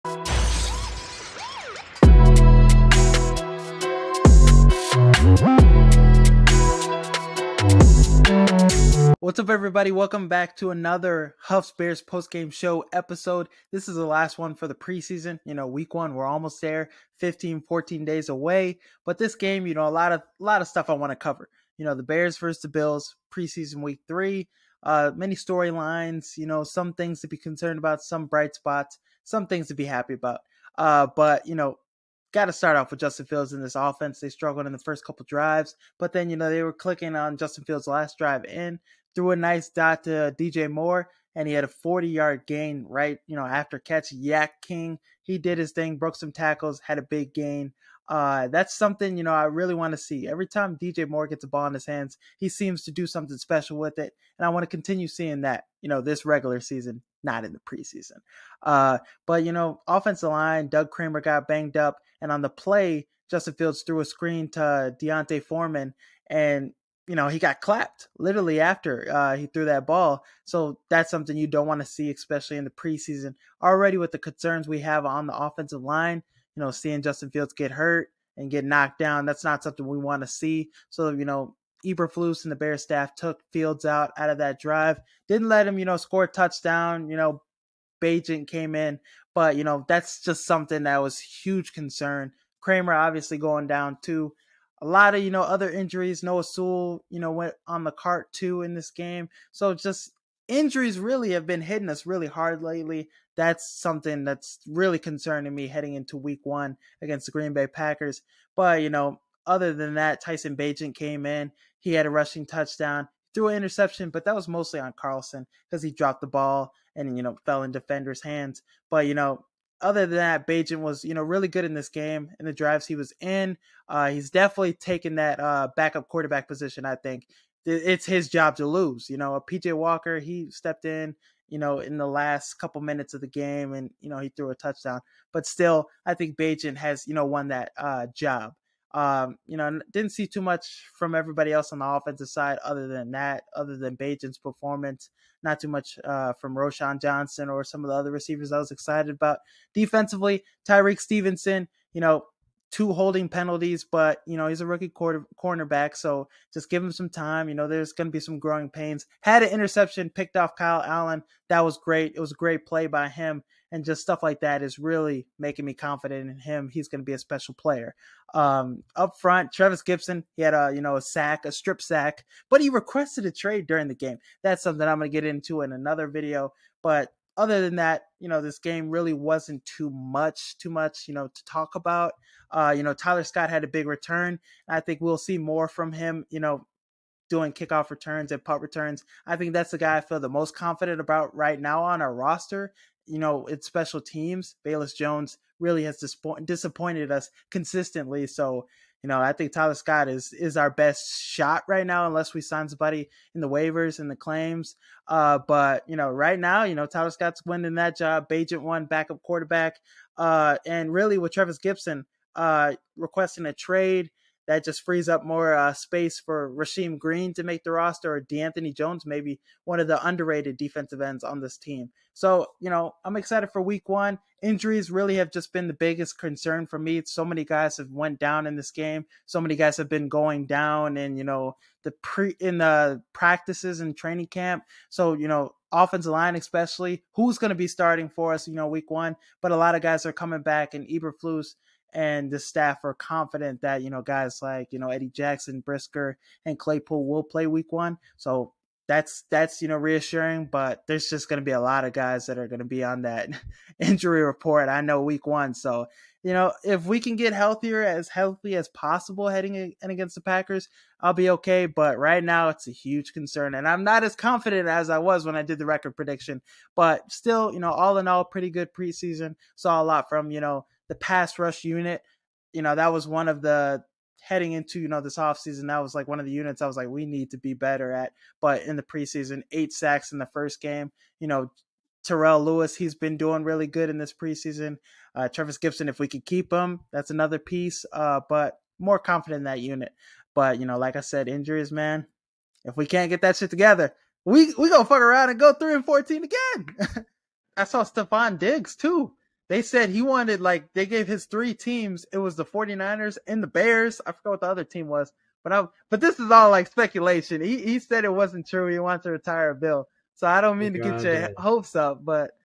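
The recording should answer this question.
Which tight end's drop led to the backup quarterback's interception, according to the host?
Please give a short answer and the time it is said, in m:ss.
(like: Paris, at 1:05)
Carlson, at 1:54.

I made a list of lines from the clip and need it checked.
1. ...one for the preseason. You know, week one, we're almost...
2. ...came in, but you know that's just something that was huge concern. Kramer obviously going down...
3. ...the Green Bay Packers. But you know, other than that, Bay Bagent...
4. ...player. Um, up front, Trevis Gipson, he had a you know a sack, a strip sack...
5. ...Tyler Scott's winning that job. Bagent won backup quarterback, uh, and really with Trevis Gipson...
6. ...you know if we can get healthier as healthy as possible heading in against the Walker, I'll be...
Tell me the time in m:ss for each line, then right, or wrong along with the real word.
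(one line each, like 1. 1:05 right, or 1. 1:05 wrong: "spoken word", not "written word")
1. 0:14 right
2. 1:28 right
3. 1:47 wrong: "Tyson", not "Bay"
4. 2:47 right
5. 3:26 right
6. 4:16 wrong: "Packers", not "Walker".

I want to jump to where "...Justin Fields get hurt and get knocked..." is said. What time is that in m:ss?
1:17.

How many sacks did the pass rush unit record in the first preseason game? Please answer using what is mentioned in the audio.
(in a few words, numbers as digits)
8.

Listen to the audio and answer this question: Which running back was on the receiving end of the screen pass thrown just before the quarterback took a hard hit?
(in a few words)
D'Onta Foreman.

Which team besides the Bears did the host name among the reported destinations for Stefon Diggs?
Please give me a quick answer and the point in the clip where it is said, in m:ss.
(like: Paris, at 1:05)
49ers, at 5:02.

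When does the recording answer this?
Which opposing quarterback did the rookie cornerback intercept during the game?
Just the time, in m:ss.
2:40.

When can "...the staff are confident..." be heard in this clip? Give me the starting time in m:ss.
4:02.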